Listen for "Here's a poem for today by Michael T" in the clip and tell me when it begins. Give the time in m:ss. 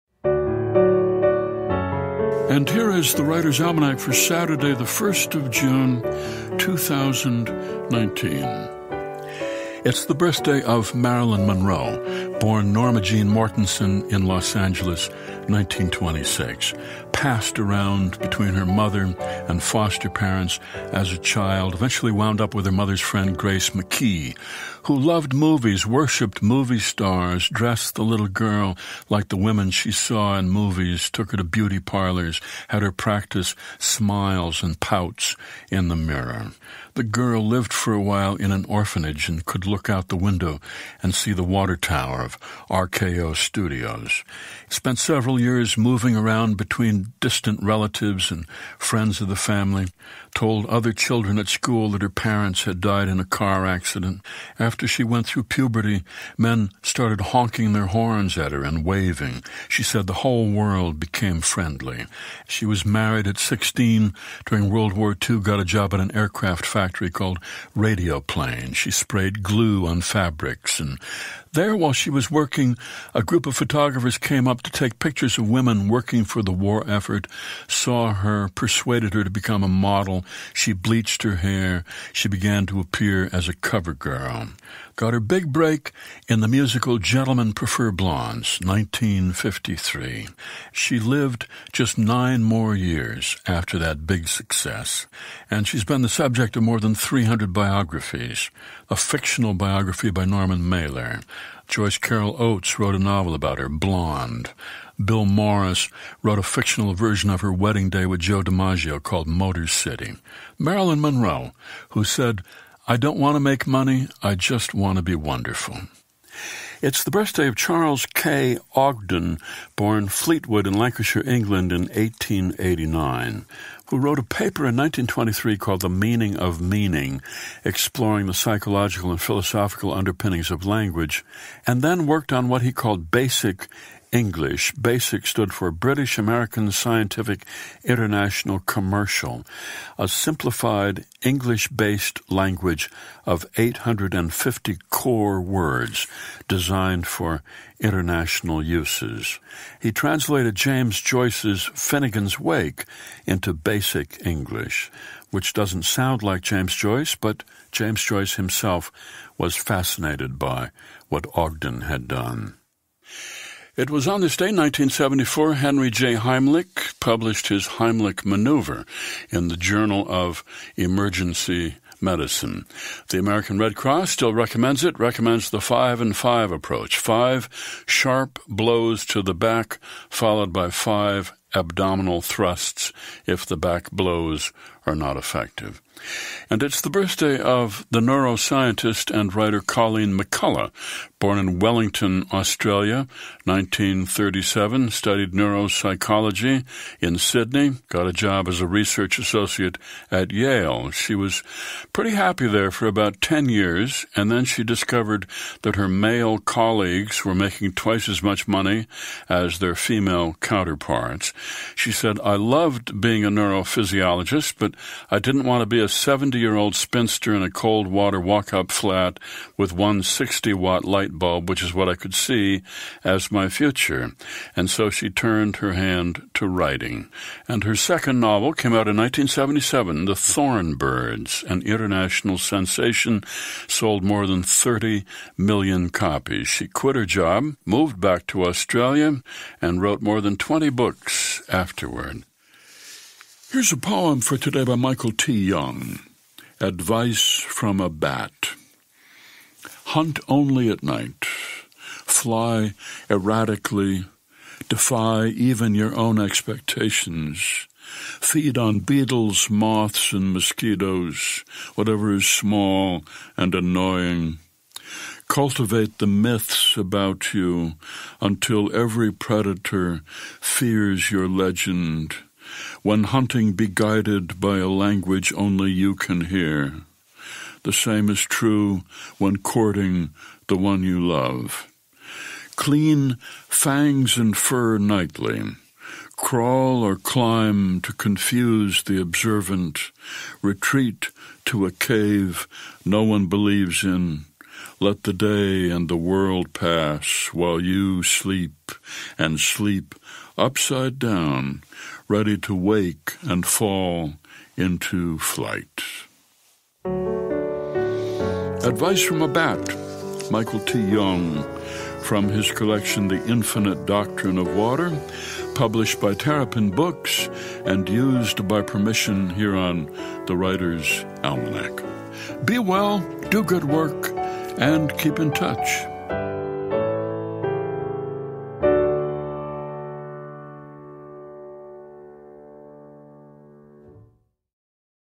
4:03.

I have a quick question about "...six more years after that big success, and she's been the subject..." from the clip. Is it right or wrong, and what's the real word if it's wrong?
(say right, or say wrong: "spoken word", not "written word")
wrong: "nine", not "six".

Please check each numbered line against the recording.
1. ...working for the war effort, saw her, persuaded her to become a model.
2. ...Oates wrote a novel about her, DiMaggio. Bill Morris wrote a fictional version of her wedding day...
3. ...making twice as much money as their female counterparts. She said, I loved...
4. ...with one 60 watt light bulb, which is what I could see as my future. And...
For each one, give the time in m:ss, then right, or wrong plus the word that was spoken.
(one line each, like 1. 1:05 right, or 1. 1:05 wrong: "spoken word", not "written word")
1. 1:15 right
2. 1:42 wrong: "Blonde", not "DiMaggio"
3. 3:27 right
4. 3:39 right.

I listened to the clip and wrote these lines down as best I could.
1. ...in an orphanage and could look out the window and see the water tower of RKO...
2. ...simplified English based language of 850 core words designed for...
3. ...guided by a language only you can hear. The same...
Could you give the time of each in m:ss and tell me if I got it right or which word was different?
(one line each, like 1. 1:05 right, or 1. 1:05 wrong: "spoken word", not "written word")
1. 0:38 right
2. 2:20 right
3. 4:33 right.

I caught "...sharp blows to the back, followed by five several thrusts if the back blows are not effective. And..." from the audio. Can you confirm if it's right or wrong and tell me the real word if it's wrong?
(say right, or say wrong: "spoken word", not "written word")
wrong: "abdominal", not "several".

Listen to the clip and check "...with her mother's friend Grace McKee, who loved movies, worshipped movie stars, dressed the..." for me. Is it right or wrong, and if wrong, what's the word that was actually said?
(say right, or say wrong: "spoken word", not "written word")
right.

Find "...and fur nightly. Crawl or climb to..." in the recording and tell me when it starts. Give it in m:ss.
4:44.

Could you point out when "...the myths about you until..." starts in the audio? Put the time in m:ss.
4:25.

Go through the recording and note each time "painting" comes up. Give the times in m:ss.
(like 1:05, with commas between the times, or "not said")
not said.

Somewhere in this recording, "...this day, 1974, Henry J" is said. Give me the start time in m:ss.
2:44.